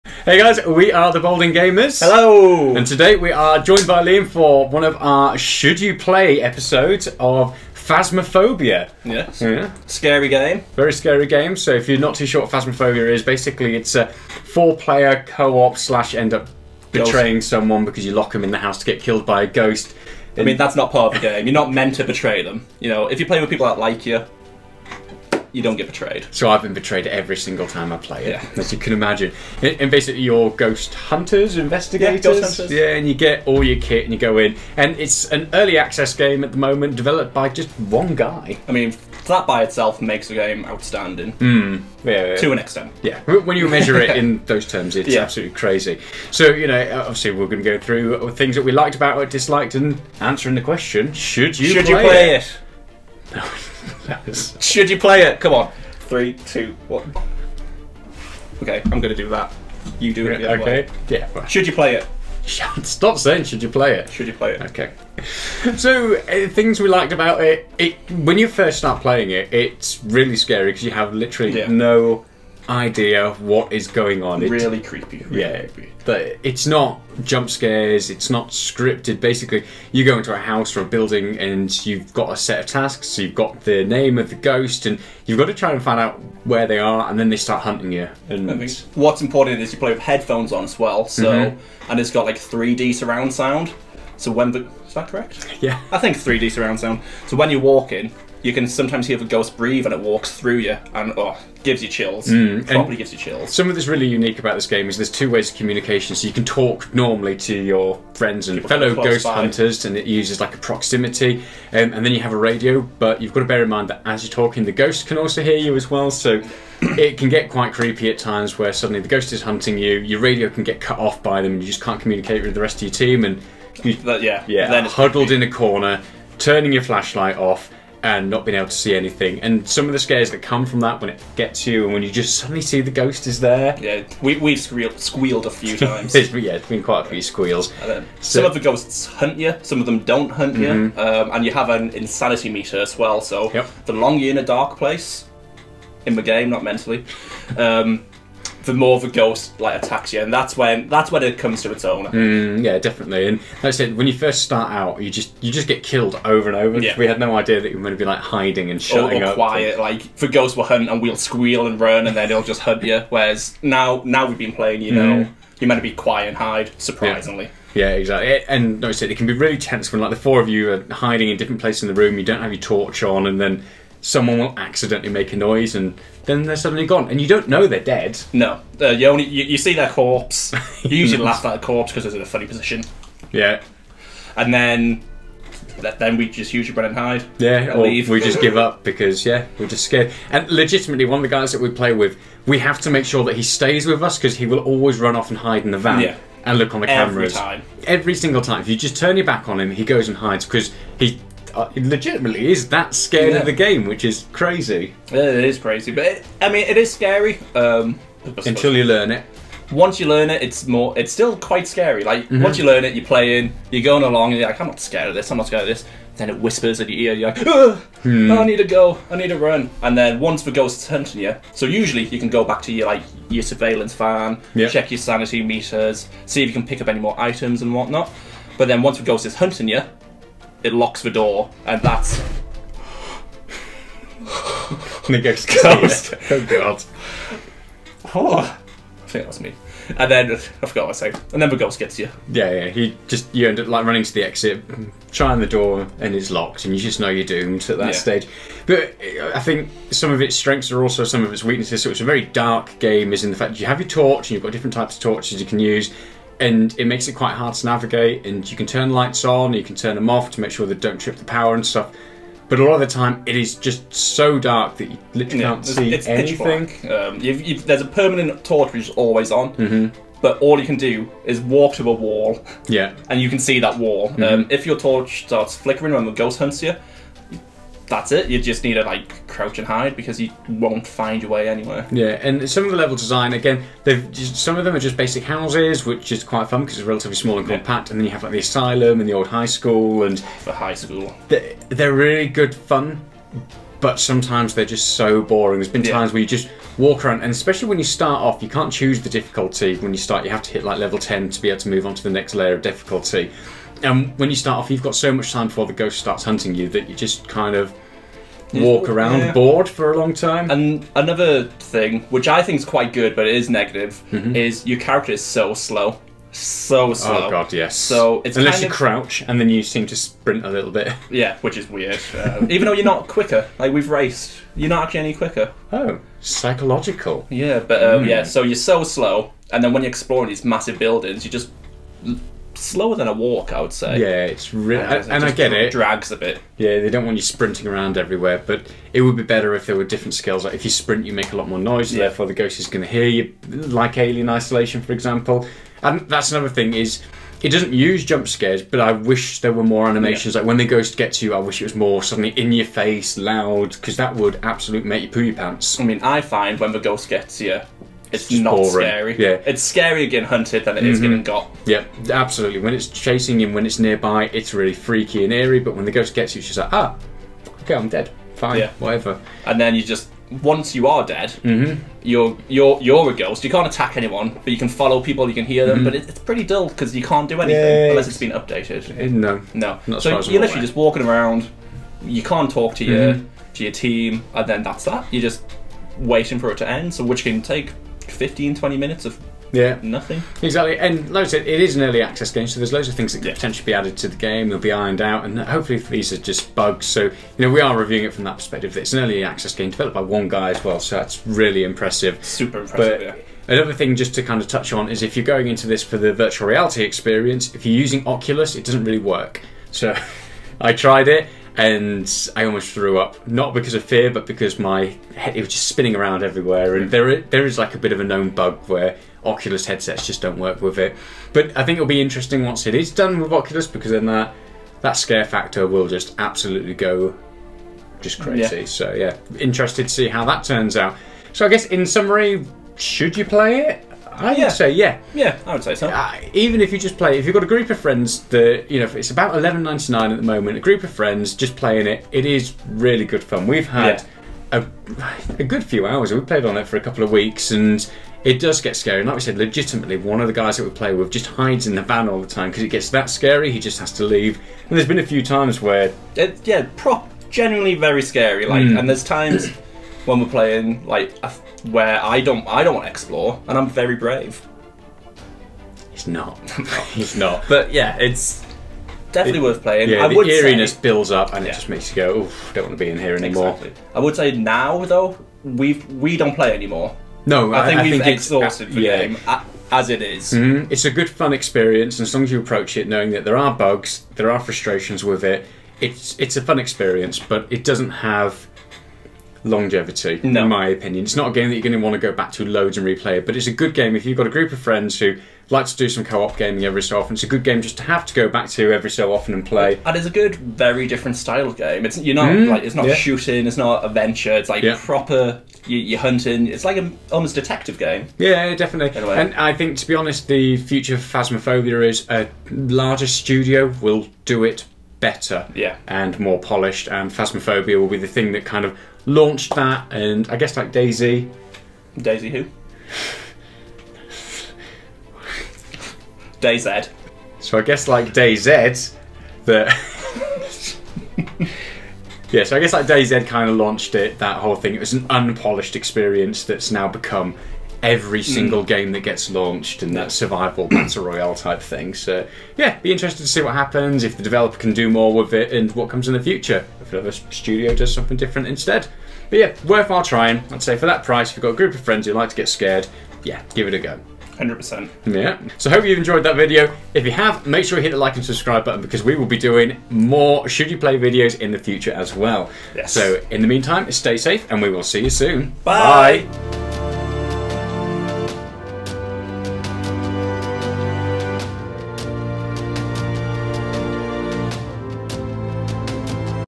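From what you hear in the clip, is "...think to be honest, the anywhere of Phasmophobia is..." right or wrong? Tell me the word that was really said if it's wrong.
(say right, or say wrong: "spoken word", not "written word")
wrong: "future", not "anywhere".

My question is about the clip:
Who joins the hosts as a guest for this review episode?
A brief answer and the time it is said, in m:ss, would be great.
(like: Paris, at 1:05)
Liam, at 0:04.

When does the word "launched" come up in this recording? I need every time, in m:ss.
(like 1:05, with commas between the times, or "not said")
8:39, 8:53, 8:59.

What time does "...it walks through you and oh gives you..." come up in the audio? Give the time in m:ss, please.
1:39.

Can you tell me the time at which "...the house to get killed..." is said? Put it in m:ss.
0:18.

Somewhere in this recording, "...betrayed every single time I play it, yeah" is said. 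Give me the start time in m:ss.
0:26.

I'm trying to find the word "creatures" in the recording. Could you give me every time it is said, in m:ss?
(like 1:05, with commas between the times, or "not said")
not said.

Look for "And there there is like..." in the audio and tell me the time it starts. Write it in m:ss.
6:56.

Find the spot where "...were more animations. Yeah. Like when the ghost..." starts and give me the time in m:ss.
5:49.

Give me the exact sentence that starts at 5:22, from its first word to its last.
Um, even though you're not quicker, like we've raced, you're not actually any quicker.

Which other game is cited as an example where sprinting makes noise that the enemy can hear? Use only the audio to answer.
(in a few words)
Alien Isolation.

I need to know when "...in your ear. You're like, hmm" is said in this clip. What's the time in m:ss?
3:36.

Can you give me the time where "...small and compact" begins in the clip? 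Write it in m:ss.
4:47.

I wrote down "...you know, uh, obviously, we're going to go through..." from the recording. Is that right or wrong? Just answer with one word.
right.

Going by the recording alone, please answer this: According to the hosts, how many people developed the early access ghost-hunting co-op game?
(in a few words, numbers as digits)
1.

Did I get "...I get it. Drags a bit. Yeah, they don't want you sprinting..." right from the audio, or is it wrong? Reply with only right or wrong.
right.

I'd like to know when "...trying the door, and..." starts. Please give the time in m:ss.
4:05.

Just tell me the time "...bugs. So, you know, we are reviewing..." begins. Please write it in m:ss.
6:36.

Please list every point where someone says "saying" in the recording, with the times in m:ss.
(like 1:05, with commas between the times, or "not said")
1:03.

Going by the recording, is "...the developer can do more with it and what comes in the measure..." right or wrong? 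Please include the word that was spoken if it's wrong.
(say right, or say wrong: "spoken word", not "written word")
wrong: "future", not "measure".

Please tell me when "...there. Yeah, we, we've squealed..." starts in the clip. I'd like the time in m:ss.
2:13.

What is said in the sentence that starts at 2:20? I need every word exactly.
um, and you have an insanity meter as well.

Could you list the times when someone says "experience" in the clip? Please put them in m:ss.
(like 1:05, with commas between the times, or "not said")
6:46, 8:01, 8:06, 8:55.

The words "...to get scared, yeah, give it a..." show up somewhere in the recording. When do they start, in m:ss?
9:12.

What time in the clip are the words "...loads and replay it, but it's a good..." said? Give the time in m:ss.
8:12.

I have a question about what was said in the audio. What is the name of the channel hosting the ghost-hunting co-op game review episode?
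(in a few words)
Balding Gamers.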